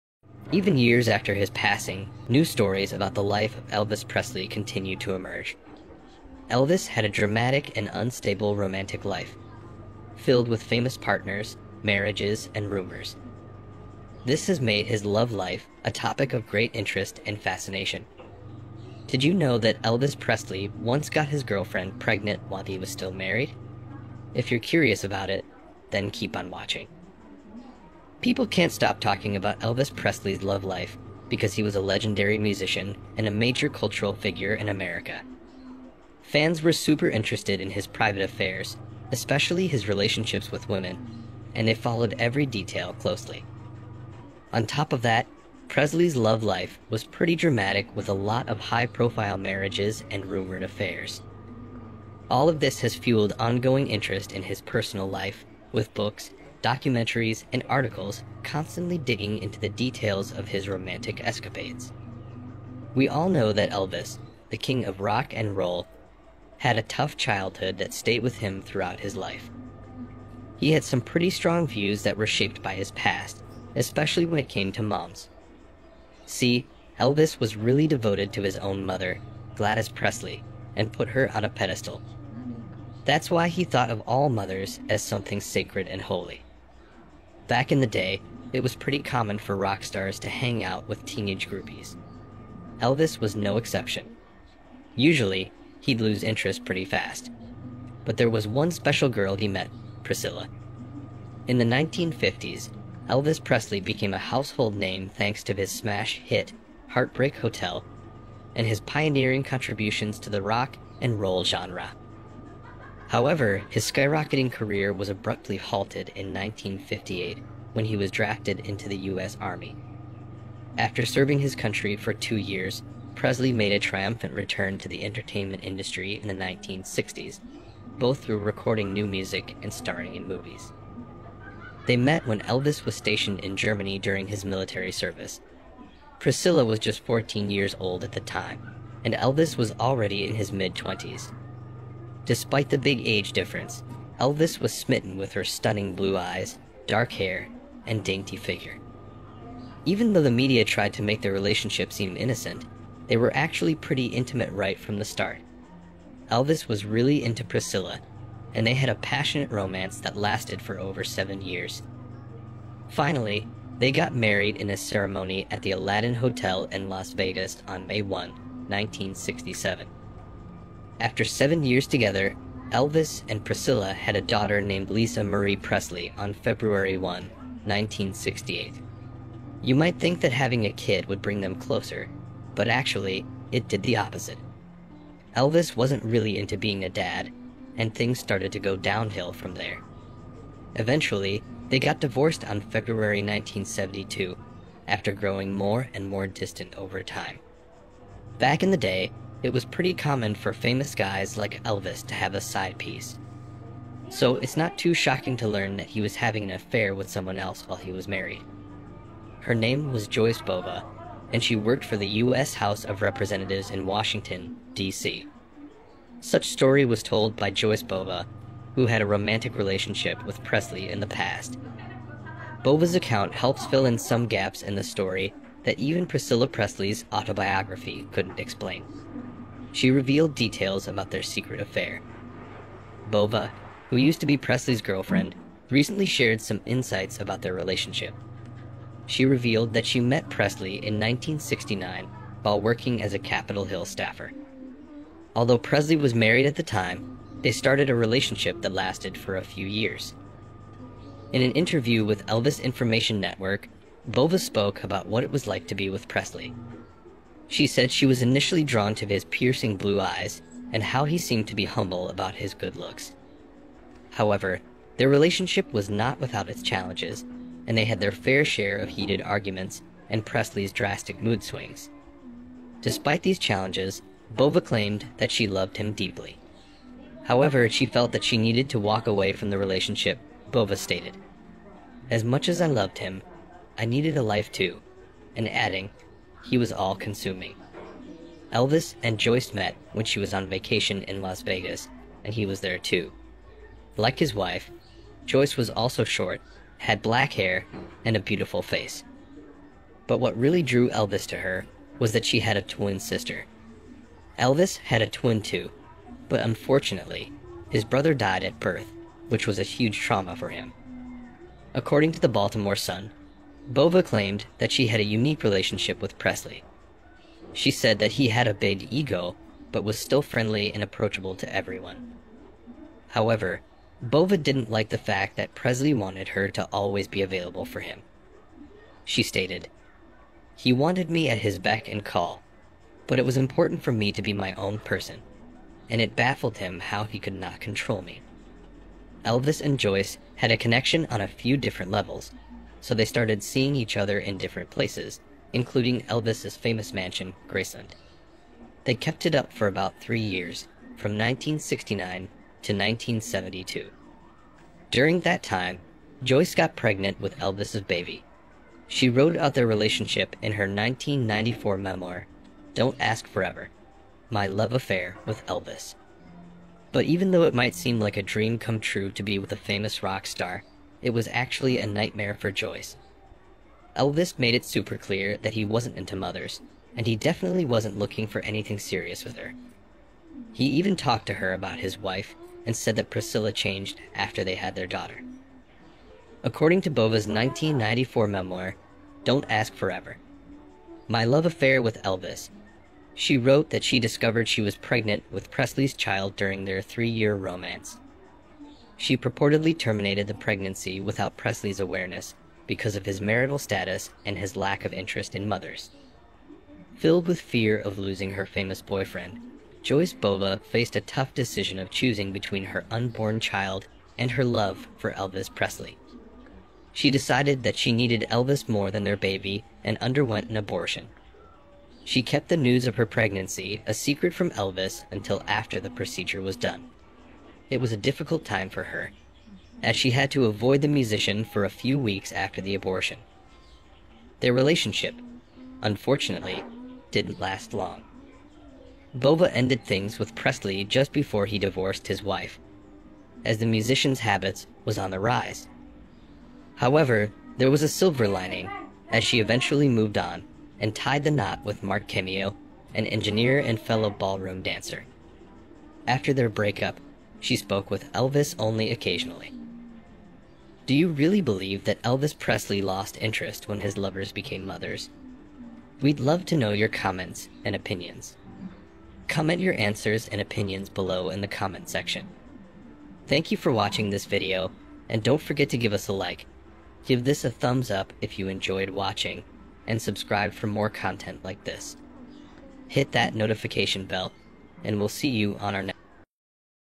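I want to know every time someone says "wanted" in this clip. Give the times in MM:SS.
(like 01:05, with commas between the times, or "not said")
05:25, 05:30.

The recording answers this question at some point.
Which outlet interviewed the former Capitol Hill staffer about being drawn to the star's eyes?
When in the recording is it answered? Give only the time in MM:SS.
04:12.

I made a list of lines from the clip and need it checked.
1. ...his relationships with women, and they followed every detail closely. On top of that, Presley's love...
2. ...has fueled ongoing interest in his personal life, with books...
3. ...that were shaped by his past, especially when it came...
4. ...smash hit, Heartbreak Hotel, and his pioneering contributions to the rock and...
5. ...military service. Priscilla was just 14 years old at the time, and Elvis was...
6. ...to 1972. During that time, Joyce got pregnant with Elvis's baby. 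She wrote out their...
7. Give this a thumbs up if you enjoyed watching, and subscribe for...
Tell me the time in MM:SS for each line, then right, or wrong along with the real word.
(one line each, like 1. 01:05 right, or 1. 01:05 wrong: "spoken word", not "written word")
1. 00:39 right
2. 00:52 right
3. 01:12 right
4. 01:45 right
5. 02:14 right
6. 05:52 right
7. 07:57 right.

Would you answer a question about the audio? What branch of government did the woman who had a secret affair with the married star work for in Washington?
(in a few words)
U.S. House of Representatives.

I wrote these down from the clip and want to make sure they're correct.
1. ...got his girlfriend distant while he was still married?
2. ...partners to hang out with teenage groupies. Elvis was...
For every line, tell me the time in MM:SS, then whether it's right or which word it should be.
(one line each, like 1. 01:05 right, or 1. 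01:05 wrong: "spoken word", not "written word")
1. 00:21 wrong: "pregnant", not "distant"
2. 01:29 wrong: "stars", not "partners".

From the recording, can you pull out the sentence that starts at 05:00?
But what really drew Elvis to her was that she had a twin sister.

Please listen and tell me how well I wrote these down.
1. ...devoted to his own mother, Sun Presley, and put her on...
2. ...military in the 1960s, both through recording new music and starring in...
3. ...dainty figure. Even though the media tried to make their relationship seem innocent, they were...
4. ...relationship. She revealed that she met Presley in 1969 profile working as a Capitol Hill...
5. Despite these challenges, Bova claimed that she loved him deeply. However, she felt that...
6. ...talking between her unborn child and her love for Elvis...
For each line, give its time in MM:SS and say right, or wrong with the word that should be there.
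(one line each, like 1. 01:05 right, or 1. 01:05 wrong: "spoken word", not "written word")
1. 01:17 wrong: "Gladys", not "Sun"
2. 02:05 wrong: "industry", not "military"
3. 02:28 right
4. 03:57 wrong: "while", not "profile"
5. 04:32 right
6. 06:51 wrong: "choosing", not "talking".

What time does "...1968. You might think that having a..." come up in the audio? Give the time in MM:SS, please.
02:57.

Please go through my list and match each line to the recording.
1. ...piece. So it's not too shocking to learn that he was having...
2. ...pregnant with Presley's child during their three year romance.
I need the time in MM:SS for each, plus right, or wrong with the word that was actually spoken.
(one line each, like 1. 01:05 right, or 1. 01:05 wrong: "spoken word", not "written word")
1. 03:22 right
2. 06:34 right.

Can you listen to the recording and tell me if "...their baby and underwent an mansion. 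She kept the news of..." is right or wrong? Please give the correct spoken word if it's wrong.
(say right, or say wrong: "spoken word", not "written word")
wrong: "abortion", not "mansion".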